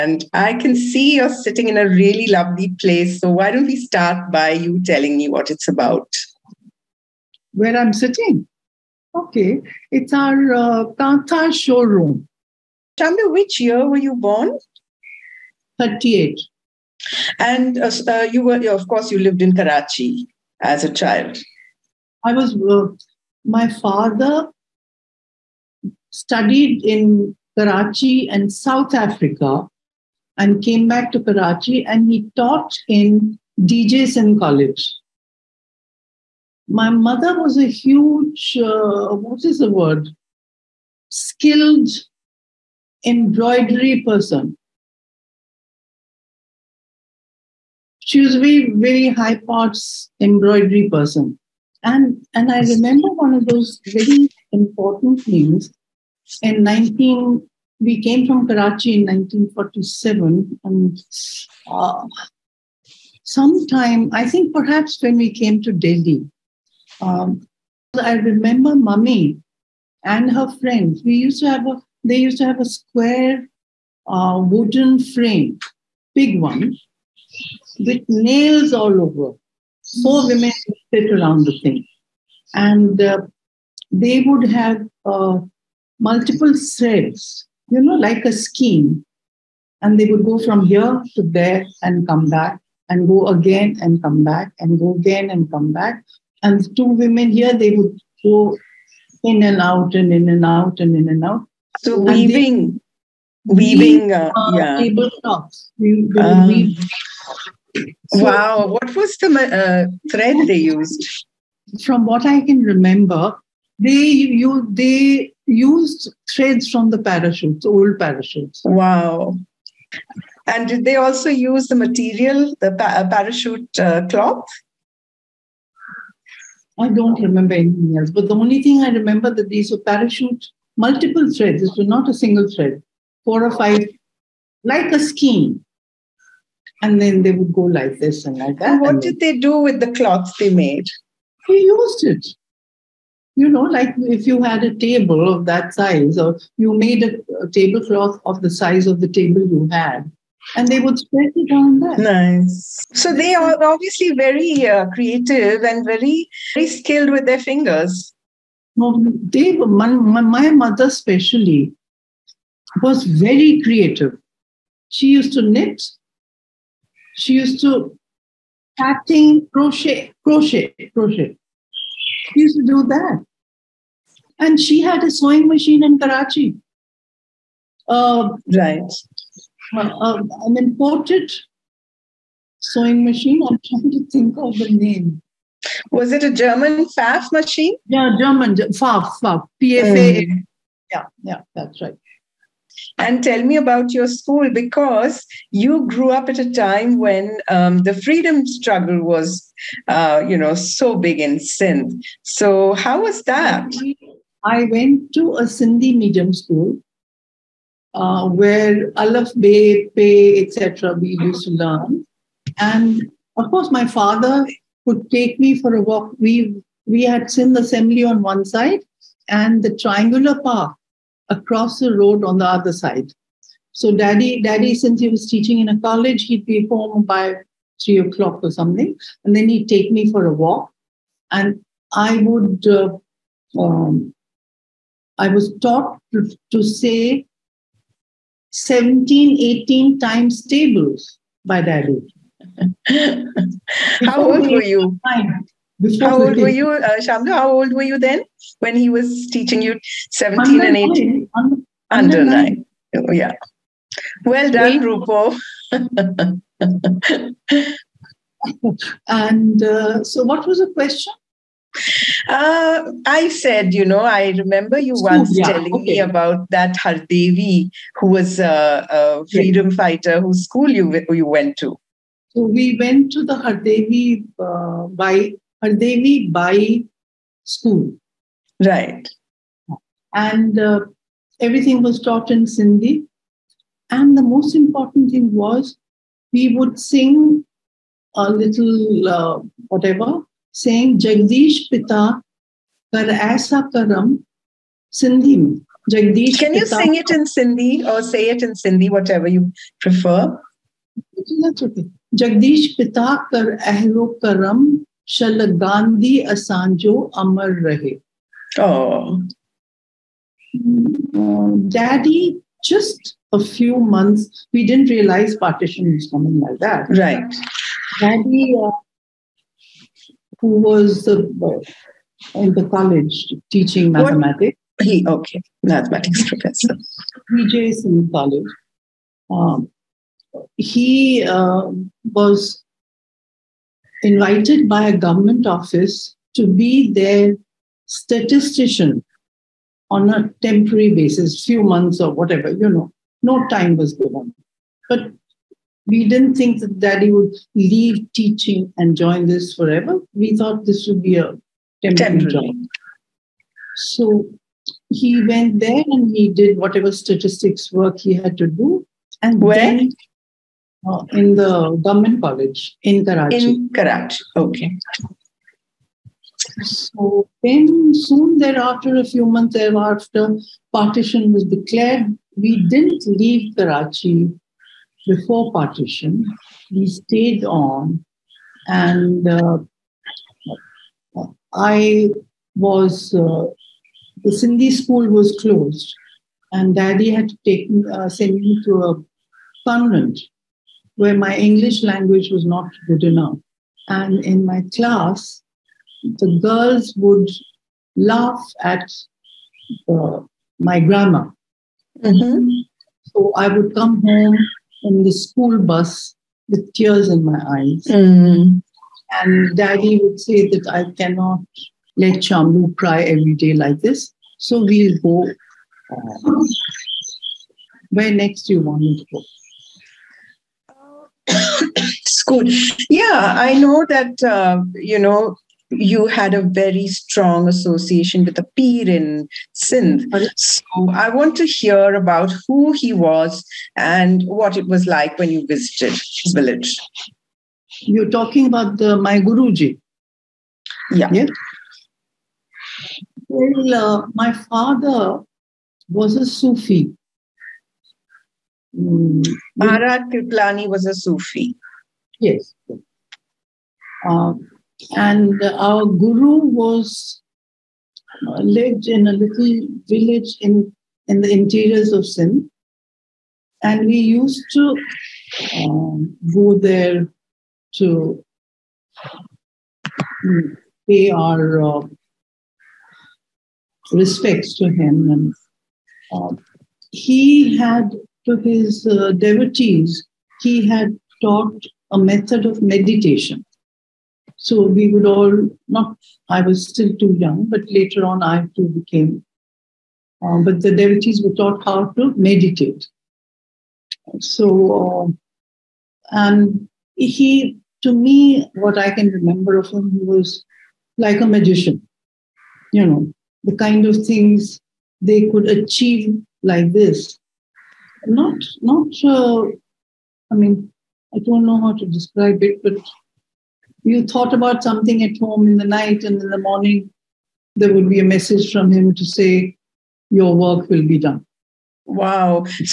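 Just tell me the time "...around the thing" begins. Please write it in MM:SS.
01:21.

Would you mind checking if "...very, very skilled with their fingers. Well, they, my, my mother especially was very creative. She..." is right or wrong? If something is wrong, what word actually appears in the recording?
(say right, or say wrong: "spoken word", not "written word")
right.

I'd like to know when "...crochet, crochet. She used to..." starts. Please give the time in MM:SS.
02:50.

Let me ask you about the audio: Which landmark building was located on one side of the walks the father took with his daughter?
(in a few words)
Sindh Assembly.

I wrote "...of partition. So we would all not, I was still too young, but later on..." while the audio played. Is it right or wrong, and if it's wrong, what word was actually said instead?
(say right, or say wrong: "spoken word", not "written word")
wrong: "meditation", not "partition".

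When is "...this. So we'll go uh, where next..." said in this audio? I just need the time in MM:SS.
06:53.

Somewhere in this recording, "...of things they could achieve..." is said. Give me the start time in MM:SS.
08:23.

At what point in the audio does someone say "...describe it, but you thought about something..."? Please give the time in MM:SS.
08:31.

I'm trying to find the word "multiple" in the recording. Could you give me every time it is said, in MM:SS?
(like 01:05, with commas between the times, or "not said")
01:25, 02:10.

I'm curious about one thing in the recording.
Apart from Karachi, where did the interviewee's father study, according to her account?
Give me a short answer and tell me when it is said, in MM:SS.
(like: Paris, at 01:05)
South Africa, at 00:28.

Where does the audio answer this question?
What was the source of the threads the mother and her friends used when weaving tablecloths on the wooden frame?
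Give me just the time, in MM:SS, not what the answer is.
01:57.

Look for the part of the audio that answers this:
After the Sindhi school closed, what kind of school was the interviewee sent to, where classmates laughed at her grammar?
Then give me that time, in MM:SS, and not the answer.
06:29.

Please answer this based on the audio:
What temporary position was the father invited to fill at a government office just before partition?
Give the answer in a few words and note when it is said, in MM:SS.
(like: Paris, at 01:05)
Statistician, at 05:37.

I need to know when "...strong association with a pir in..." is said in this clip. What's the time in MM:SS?
07:06.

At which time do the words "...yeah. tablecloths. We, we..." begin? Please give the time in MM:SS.
01:44.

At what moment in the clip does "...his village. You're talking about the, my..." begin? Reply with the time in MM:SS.
07:16.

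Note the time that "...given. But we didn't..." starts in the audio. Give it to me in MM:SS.
05:43.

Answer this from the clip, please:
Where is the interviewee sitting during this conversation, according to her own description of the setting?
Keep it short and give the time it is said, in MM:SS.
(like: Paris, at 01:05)
Tata showroom, at 00:10.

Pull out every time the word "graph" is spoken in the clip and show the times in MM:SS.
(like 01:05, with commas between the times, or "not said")
not said.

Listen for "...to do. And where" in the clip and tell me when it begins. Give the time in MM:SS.
05:58.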